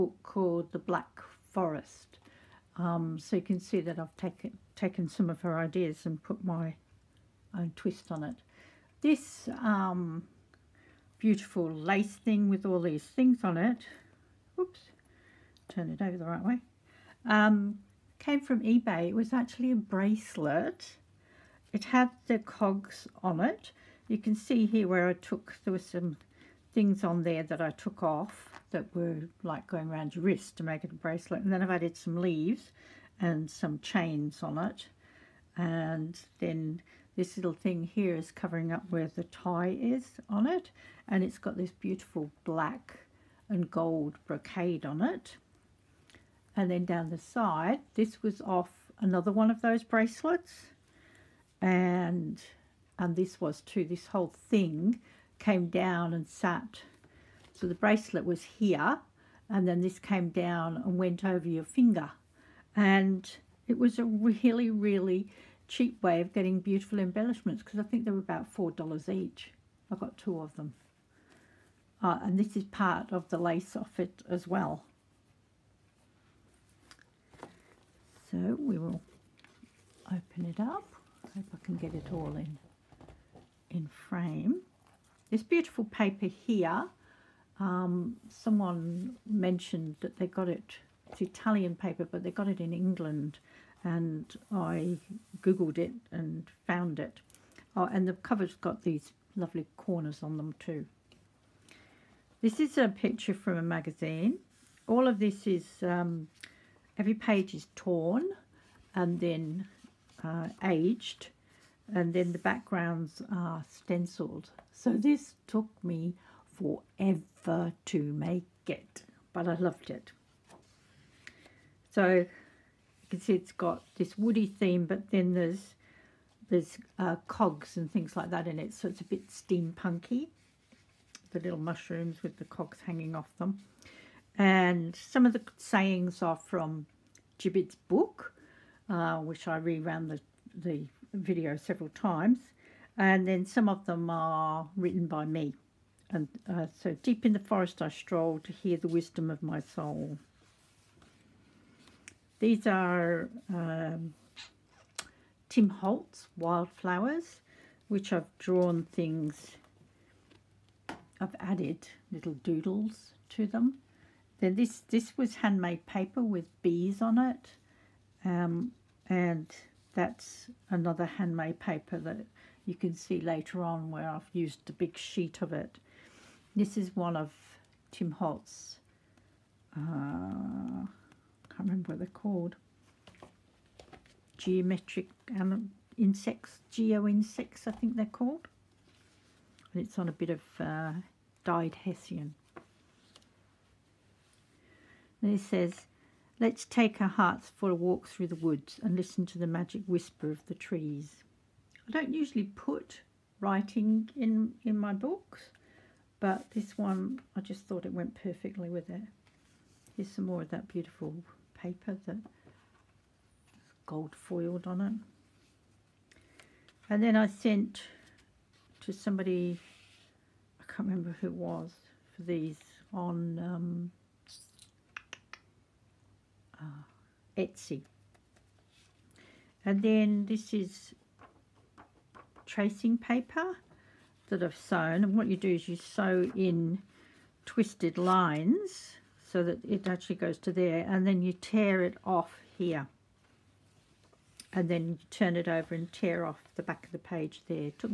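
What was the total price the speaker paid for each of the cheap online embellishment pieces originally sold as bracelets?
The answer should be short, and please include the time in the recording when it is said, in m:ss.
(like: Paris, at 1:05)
$4, at 1:08.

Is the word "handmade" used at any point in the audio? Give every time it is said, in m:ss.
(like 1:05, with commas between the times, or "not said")
2:45, 2:51.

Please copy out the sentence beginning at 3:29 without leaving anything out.
Here's some more of that beautiful paper that's gold foiled on it.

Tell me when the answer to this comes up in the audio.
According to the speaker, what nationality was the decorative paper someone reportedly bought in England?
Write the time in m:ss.
1:31.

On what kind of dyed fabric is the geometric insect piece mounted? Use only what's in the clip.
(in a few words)
Hessian.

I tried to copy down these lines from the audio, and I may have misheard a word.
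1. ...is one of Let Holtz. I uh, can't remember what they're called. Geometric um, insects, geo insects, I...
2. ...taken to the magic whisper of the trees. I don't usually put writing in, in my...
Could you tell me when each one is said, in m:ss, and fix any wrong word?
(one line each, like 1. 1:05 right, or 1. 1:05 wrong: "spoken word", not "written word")
1. 2:56 wrong: "Tim", not "Let"
2. 3:18 wrong: "listen", not "taken".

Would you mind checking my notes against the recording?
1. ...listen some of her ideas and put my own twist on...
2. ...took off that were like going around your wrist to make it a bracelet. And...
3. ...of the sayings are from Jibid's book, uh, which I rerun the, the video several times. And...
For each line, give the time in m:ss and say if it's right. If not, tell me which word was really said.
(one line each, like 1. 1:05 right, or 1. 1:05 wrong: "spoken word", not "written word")
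1. 0:04 wrong: "taken", not "listen"
2. 0:27 right
3. 2:15 right.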